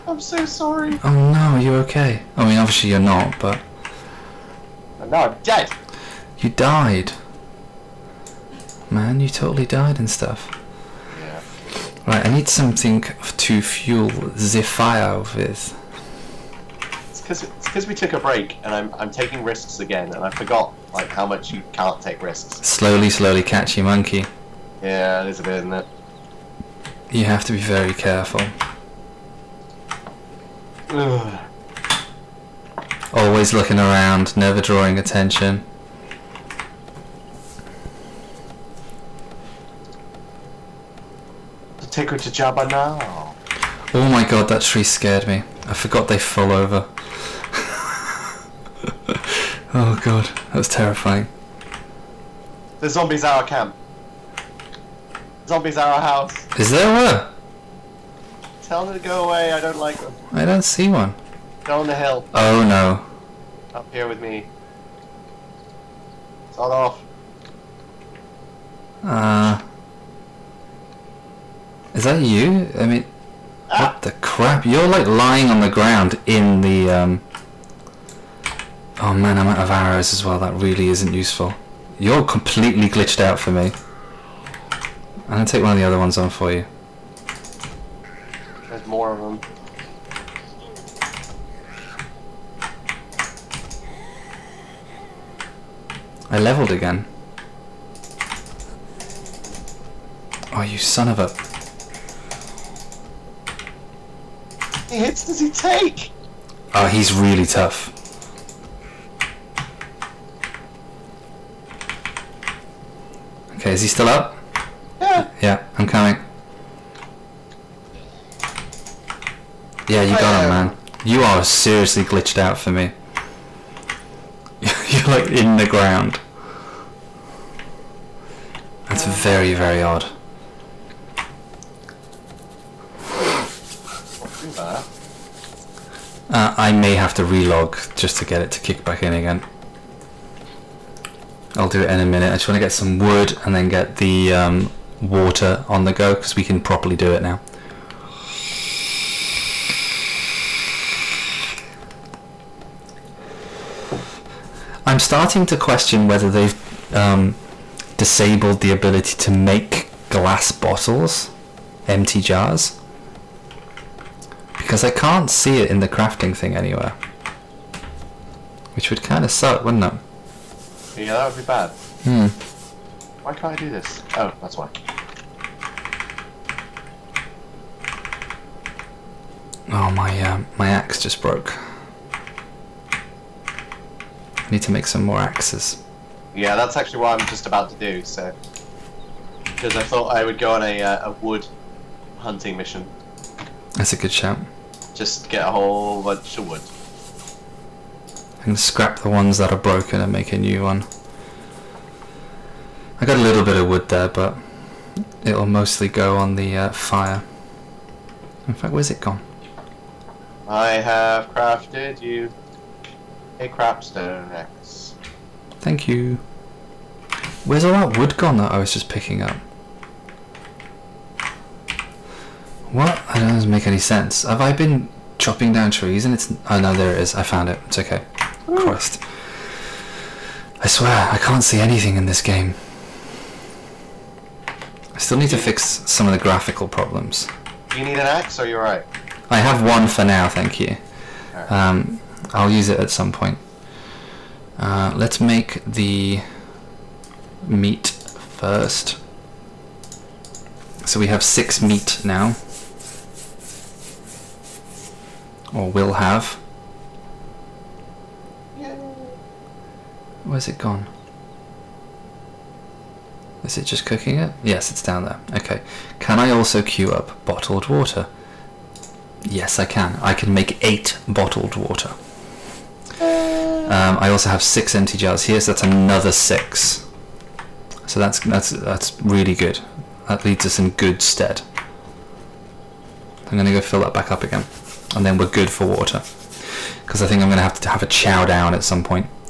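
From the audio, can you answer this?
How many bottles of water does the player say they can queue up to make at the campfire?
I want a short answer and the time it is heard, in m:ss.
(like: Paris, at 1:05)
8, at 4:30.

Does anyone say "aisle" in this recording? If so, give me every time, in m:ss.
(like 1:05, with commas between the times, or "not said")
not said.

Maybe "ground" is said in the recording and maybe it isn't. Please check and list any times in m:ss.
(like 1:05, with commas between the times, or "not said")
1:15, 2:05.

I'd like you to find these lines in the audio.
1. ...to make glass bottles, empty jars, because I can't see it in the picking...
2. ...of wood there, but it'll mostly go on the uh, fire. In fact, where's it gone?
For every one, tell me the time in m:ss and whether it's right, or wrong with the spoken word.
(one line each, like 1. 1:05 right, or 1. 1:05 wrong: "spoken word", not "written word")
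1. 2:39 wrong: "crafting", not "picking"
2. 3:23 right.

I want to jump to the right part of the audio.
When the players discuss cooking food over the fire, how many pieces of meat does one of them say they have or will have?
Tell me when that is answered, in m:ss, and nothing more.
4:11.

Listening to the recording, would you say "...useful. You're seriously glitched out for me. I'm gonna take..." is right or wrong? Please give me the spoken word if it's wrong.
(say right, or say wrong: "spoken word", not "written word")
wrong: "completely", not "seriously".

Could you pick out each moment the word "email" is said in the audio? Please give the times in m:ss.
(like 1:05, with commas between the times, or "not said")
not said.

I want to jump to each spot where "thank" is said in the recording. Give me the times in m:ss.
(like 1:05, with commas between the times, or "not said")
3:35, 4:00.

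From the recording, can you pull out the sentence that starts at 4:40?
That leads us in good stead.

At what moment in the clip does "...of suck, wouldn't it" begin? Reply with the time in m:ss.
2:49.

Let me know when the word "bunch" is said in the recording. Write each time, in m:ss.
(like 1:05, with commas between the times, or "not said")
3:16.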